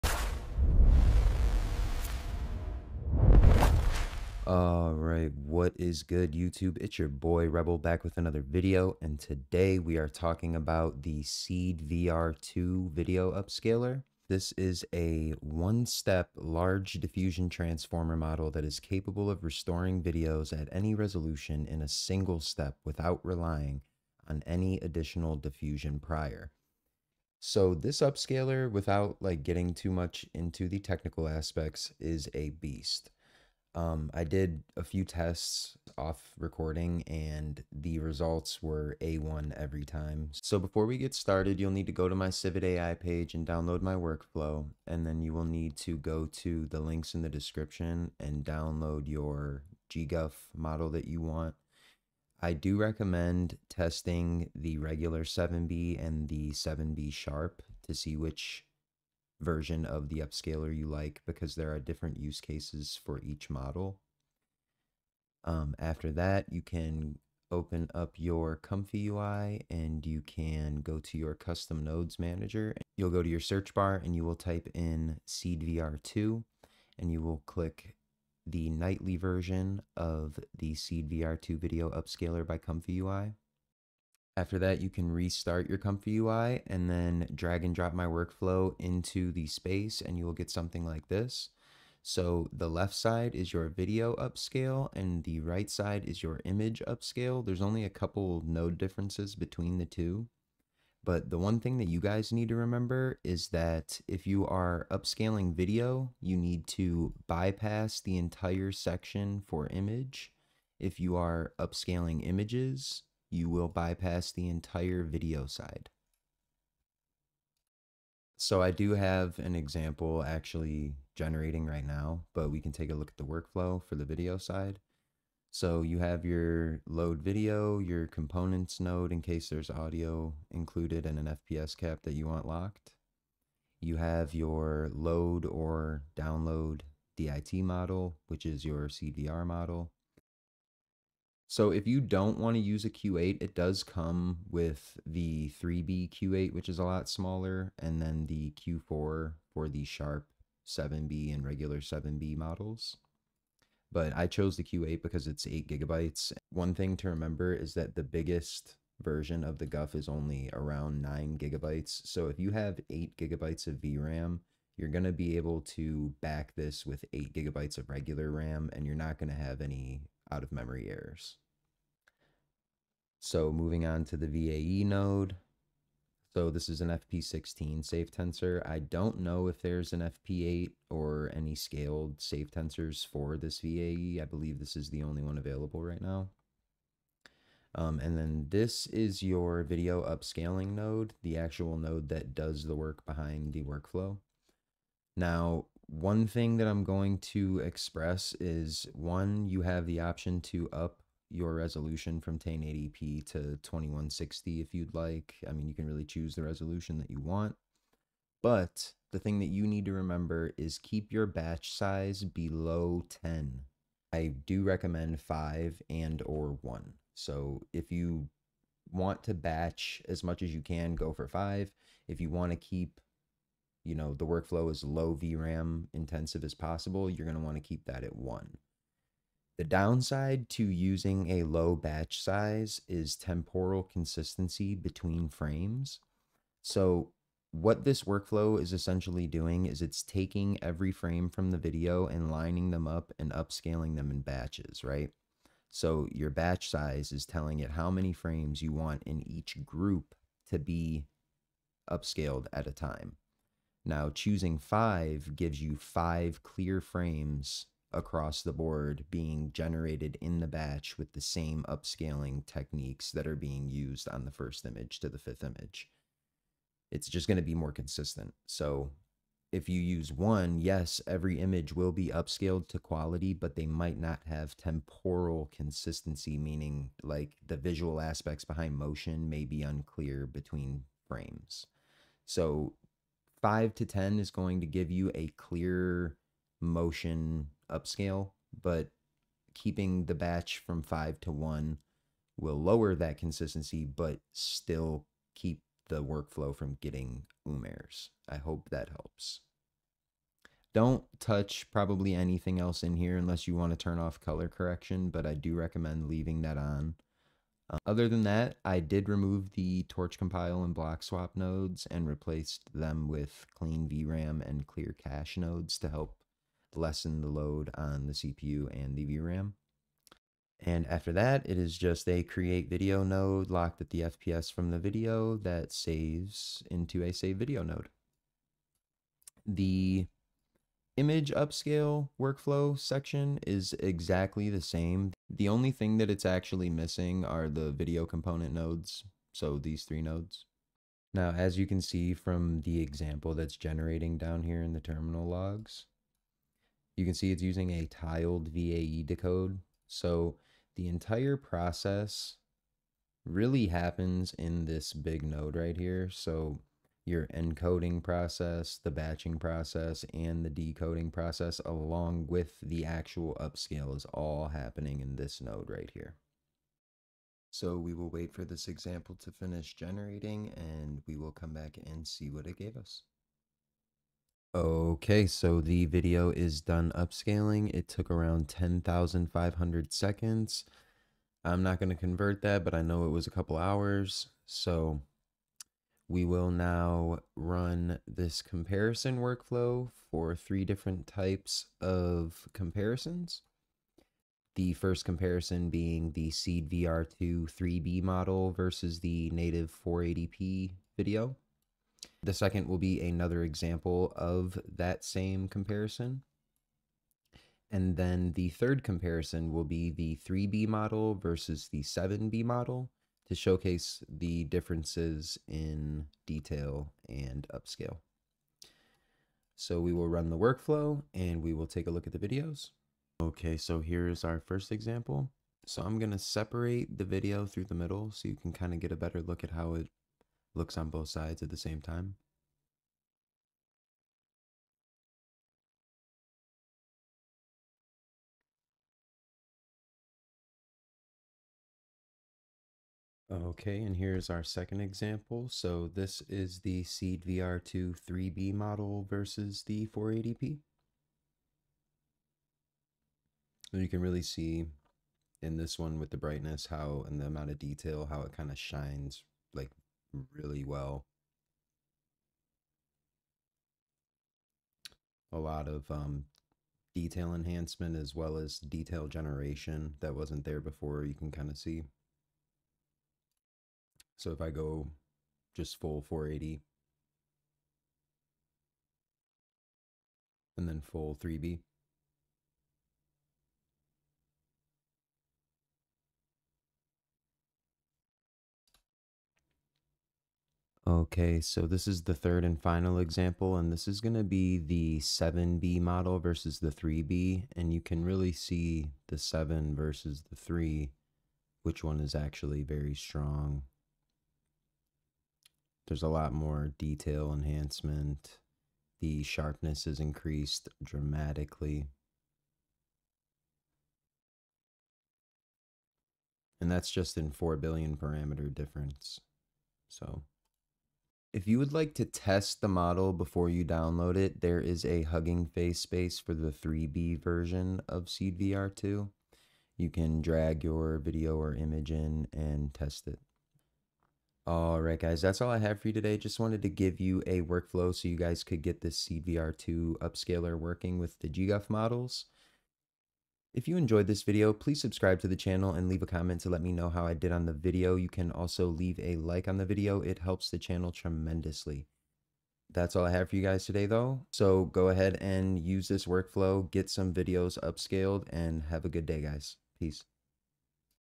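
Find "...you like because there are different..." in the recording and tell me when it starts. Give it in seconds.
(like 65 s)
60 s.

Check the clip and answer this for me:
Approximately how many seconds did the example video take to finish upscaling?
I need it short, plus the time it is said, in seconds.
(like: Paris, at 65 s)
10,500 seconds, at 378 s.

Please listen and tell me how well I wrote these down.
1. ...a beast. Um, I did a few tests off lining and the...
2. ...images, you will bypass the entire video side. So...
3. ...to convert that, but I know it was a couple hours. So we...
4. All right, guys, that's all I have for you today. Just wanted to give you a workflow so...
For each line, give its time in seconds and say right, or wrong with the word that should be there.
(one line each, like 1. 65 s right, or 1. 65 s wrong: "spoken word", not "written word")
1. 32 s wrong: "recording", not "lining"
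2. 112 s right
3. 381 s right
4. 534 s right.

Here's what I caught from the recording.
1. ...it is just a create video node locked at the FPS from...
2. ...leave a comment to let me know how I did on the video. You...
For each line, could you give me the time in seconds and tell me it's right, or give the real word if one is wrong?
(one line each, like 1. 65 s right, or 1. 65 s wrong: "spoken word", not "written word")
1. 321 s right
2. 545 s right.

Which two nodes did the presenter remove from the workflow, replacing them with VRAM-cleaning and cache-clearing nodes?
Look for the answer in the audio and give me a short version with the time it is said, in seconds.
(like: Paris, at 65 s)
torch compile and block swap, at 309 s.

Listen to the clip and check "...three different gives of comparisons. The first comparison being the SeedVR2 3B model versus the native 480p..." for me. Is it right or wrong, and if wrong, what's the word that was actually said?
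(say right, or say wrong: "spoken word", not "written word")
wrong: "types", not "gives".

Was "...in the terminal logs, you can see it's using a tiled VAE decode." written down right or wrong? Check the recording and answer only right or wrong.
right.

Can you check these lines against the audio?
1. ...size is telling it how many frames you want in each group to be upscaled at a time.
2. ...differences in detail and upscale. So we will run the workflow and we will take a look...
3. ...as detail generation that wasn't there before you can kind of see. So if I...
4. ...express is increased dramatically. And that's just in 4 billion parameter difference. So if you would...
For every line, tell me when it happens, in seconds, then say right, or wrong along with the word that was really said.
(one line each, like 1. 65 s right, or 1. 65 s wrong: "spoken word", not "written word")
1. 246 s right
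2. 414 s right
3. 468 s right
4. 509 s wrong: "sharpness", not "express".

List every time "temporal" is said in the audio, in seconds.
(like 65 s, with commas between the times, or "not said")
233 s, 274 s.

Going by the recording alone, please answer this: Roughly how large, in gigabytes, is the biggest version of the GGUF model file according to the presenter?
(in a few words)
9 gigabytes.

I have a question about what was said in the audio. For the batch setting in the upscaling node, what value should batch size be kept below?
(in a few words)
10.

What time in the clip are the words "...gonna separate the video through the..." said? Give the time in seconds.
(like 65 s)
425 s.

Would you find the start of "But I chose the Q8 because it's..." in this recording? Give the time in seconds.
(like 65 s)
153 s.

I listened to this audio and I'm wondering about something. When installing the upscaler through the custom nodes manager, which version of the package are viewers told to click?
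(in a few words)
nightly version.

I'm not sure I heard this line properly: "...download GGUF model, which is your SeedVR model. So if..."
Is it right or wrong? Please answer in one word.
wrong.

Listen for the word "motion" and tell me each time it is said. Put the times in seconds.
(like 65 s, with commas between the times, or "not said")
278 s, 286 s.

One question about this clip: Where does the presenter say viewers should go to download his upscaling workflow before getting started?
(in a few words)
Civitai page.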